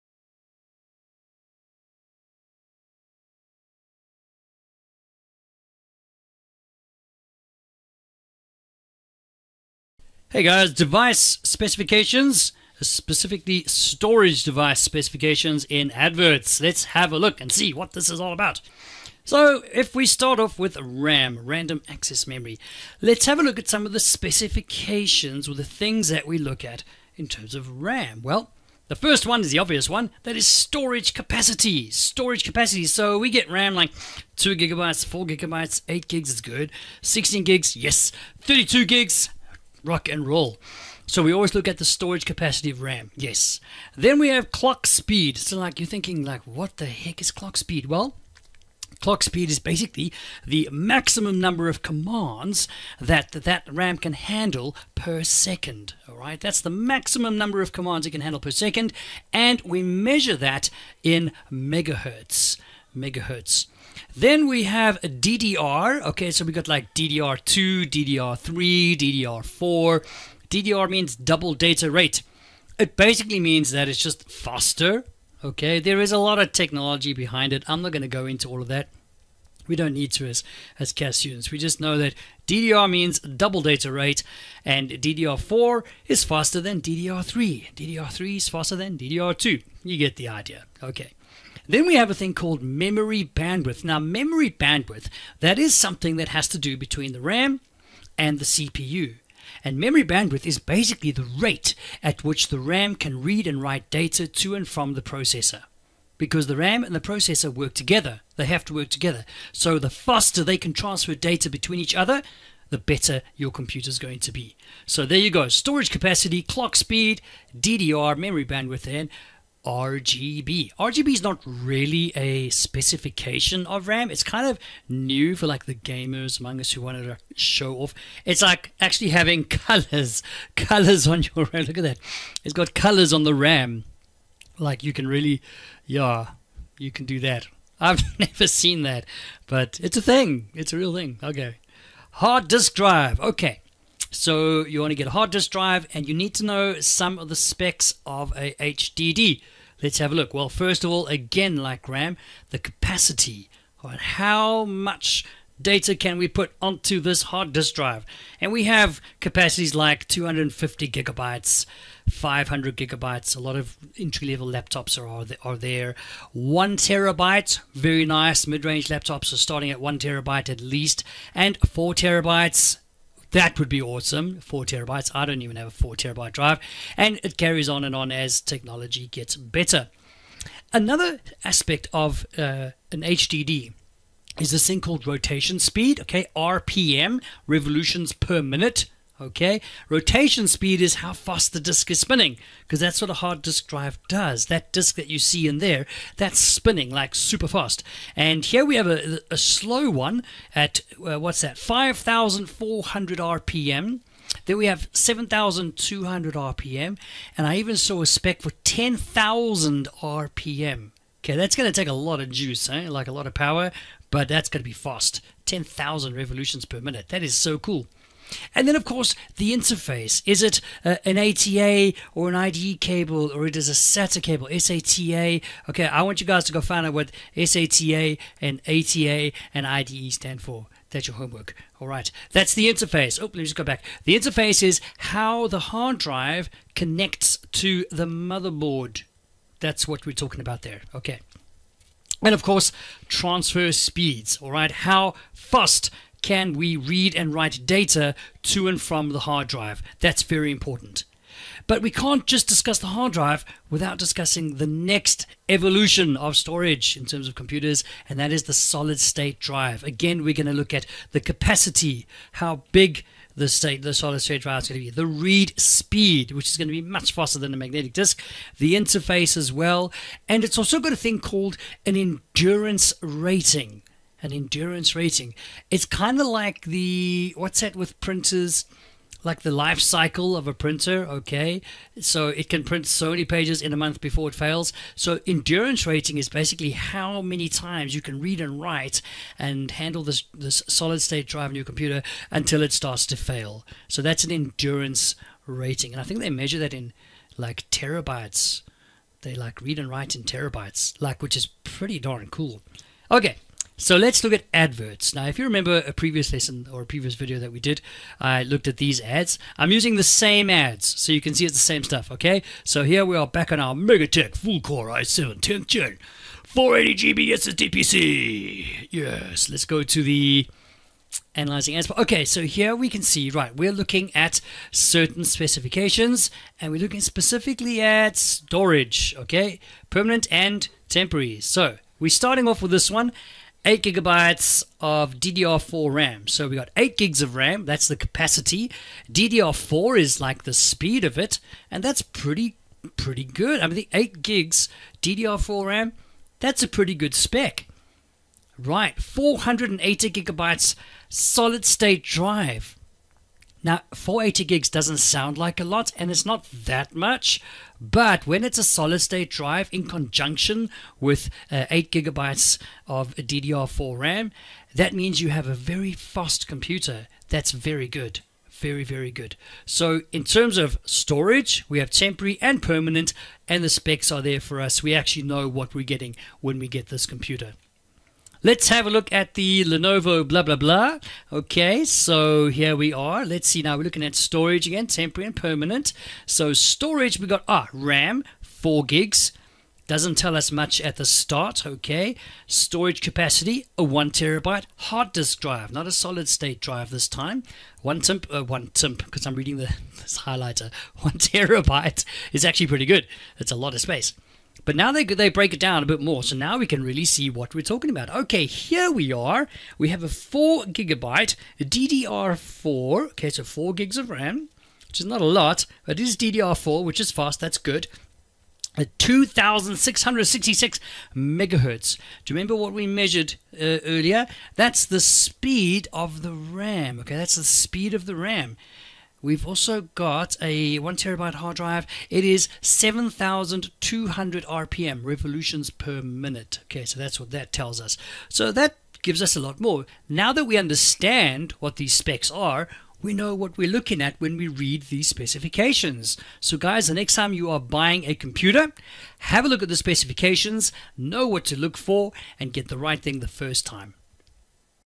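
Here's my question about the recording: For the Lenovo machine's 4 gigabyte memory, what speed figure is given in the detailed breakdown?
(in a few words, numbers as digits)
2666 MHz.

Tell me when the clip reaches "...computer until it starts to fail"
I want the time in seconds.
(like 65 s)
291 s.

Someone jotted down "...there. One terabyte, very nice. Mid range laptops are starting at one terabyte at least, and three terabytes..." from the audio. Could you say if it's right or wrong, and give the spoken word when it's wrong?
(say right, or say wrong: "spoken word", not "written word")
wrong: "four", not "three".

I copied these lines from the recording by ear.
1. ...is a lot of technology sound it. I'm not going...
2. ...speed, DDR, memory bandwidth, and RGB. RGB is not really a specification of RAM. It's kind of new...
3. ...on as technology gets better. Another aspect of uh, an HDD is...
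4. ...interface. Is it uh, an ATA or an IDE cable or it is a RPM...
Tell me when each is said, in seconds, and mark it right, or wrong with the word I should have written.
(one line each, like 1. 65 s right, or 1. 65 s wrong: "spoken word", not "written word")
1. 76 s wrong: "behind", not "sound"
2. 116 s right
3. 177 s right
4. 219 s wrong: "SATA", not "RPM".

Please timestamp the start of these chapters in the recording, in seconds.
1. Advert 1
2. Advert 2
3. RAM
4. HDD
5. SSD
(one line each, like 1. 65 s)
1. 303 s
2. 378 s
3. 19 s
4. 141 s
5. 251 s.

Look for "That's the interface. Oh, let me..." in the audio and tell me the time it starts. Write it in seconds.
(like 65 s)
232 s.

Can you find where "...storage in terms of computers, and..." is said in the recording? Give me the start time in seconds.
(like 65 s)
256 s.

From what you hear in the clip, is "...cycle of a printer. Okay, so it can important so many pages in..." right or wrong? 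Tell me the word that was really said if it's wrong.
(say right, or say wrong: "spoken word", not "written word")
wrong: "print", not "important".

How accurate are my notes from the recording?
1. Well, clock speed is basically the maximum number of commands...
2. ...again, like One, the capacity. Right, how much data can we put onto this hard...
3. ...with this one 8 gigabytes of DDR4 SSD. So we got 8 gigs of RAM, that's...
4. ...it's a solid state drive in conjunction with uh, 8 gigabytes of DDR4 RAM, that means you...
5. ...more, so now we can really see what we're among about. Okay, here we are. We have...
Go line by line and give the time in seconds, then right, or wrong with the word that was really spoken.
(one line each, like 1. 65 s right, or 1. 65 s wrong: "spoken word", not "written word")
1. 47 s right
2. 151 s wrong: "RAM", not "One"
3. 332 s wrong: "RAM", not "SSD"
4. 358 s right
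5. 406 s wrong: "talking", not "among".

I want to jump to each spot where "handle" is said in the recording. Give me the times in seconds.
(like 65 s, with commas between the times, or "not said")
54 s, 58 s, 289 s.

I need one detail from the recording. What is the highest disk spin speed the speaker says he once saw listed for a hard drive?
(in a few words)
10,000 RPM.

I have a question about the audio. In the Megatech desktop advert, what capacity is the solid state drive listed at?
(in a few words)
480GB.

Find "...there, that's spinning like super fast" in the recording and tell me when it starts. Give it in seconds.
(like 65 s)
195 s.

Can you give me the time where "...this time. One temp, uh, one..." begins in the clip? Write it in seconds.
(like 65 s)
396 s.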